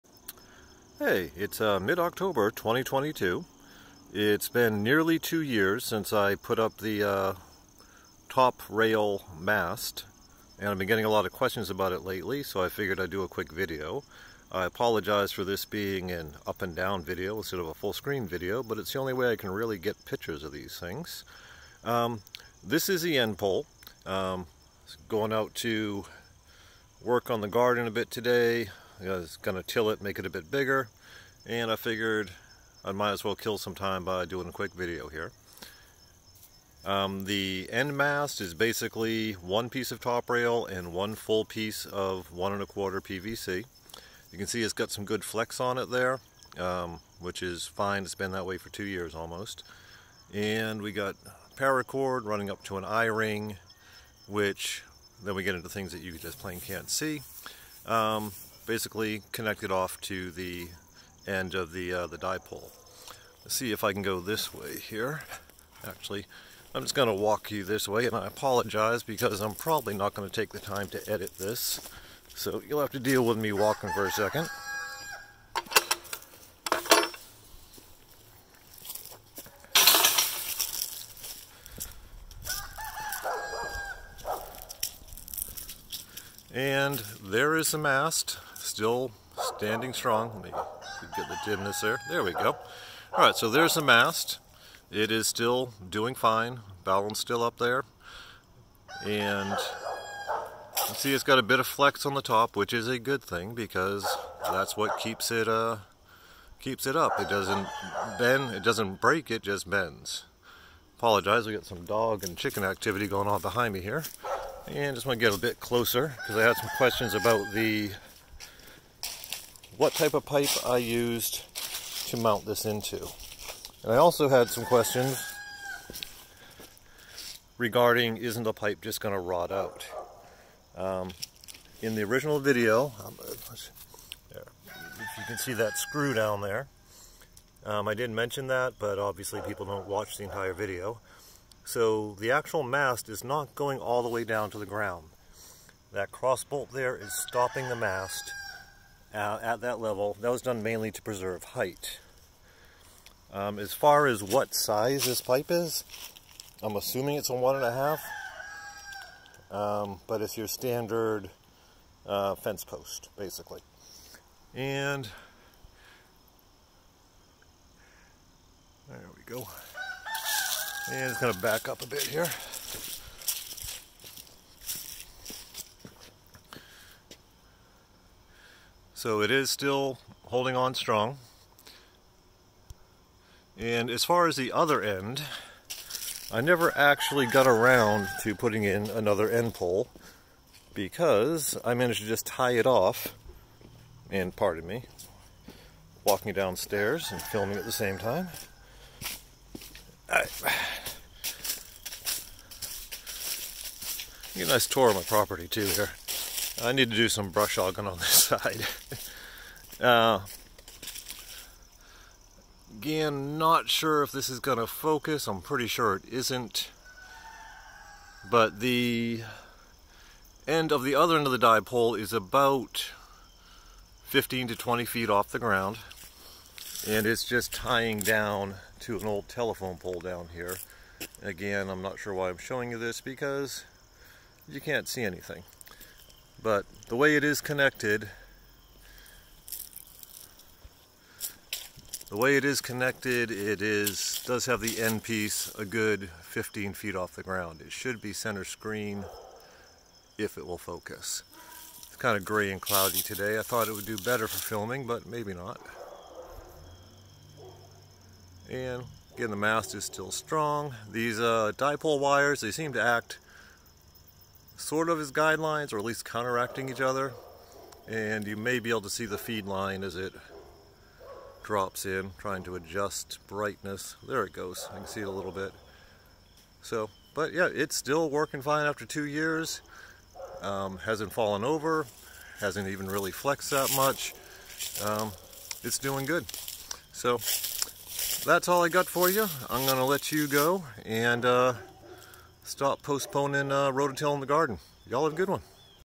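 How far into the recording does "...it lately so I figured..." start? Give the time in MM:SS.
00:11.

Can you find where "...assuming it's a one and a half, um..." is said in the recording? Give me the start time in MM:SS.
02:36.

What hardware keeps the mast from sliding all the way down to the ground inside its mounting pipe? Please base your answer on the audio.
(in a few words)
Cross bolt.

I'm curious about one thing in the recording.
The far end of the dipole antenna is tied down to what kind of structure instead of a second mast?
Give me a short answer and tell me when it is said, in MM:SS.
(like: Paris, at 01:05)
Old telephone pole, at 03:49.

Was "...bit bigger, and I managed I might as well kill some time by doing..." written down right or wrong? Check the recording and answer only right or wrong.
wrong.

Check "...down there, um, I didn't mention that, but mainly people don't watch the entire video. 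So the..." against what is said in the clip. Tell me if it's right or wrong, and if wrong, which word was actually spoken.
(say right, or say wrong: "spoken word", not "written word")
wrong: "obviously", not "mainly".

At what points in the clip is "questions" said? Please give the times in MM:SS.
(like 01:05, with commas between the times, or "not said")
00:11, 01:56, 02:04.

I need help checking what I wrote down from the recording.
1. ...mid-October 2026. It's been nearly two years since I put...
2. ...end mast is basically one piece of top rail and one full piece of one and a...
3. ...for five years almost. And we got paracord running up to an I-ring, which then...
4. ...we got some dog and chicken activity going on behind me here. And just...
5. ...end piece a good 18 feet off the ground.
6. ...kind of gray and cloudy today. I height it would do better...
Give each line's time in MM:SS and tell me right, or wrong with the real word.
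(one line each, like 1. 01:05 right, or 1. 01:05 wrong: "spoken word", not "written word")
1. 00:01 wrong: "2022", not "2026"
2. 00:37 right
3. 00:48 wrong: "two", not "five"
4. 01:51 right
5. 04:04 wrong: "15", not "18"
6. 04:11 wrong: "thought", not "height".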